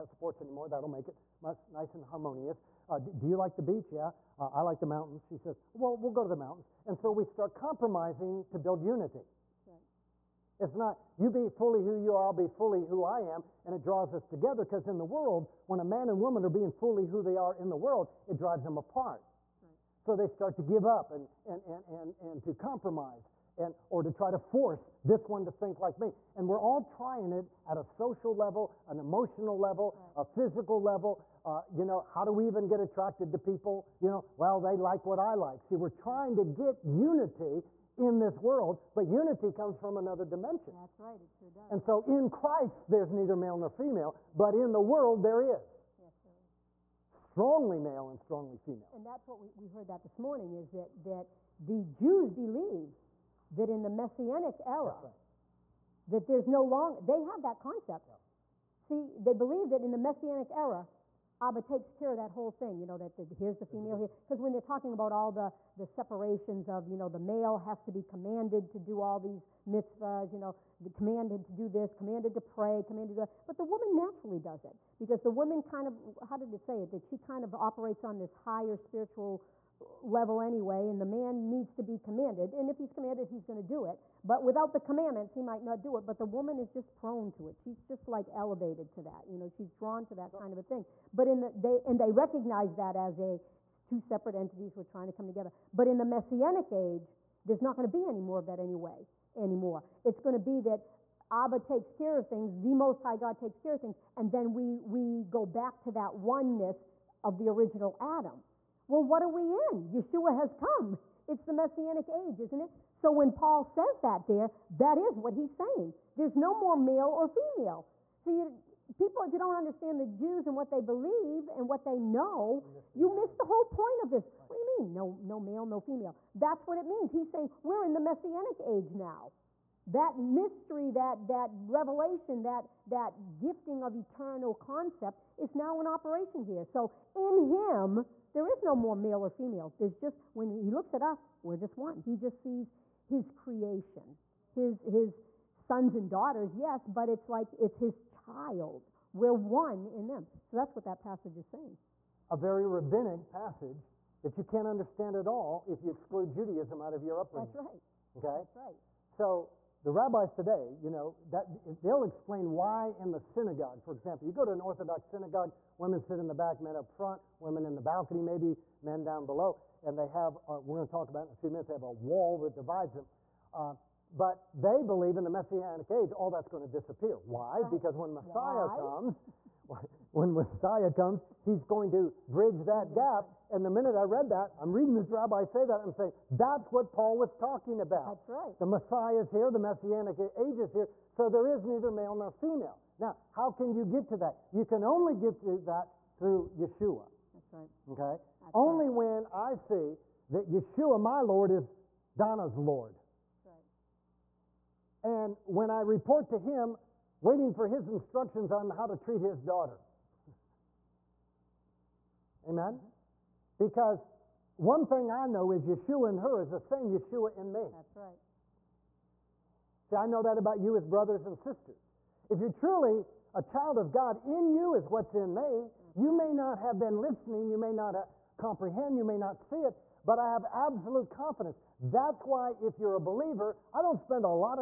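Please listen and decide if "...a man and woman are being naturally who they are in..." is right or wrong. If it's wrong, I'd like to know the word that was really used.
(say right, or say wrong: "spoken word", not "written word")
wrong: "fully", not "naturally".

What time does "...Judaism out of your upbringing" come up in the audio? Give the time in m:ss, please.
2:36.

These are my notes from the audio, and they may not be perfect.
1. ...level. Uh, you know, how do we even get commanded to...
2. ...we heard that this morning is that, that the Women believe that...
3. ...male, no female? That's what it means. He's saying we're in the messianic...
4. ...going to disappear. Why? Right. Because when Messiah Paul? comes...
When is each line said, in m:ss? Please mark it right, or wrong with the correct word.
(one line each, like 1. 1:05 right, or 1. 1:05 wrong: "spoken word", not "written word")
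1. 0:30 wrong: "attracted", not "commanded"
2. 0:49 wrong: "Jews", not "Women"
3. 2:05 right
4. 2:56 wrong: "Why", not "Paul".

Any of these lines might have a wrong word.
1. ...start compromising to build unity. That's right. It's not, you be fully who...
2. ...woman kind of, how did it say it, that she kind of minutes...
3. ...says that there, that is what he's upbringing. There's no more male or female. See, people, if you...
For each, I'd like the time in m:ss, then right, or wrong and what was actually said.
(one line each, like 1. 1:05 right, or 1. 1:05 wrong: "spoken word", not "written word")
1. 0:07 right
2. 1:15 wrong: "operates", not "minutes"
3. 1:53 wrong: "saying", not "upbringing".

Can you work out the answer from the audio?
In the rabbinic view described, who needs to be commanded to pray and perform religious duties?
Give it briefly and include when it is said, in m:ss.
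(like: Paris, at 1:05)
the man, at 1:20.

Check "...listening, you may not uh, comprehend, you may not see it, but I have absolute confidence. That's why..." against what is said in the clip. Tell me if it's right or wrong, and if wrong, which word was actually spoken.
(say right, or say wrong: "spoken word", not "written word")
right.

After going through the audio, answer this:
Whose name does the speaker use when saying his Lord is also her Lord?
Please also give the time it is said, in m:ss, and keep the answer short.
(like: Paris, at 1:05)
Donna, at 3:22.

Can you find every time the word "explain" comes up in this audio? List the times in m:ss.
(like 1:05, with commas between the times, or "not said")
2:42.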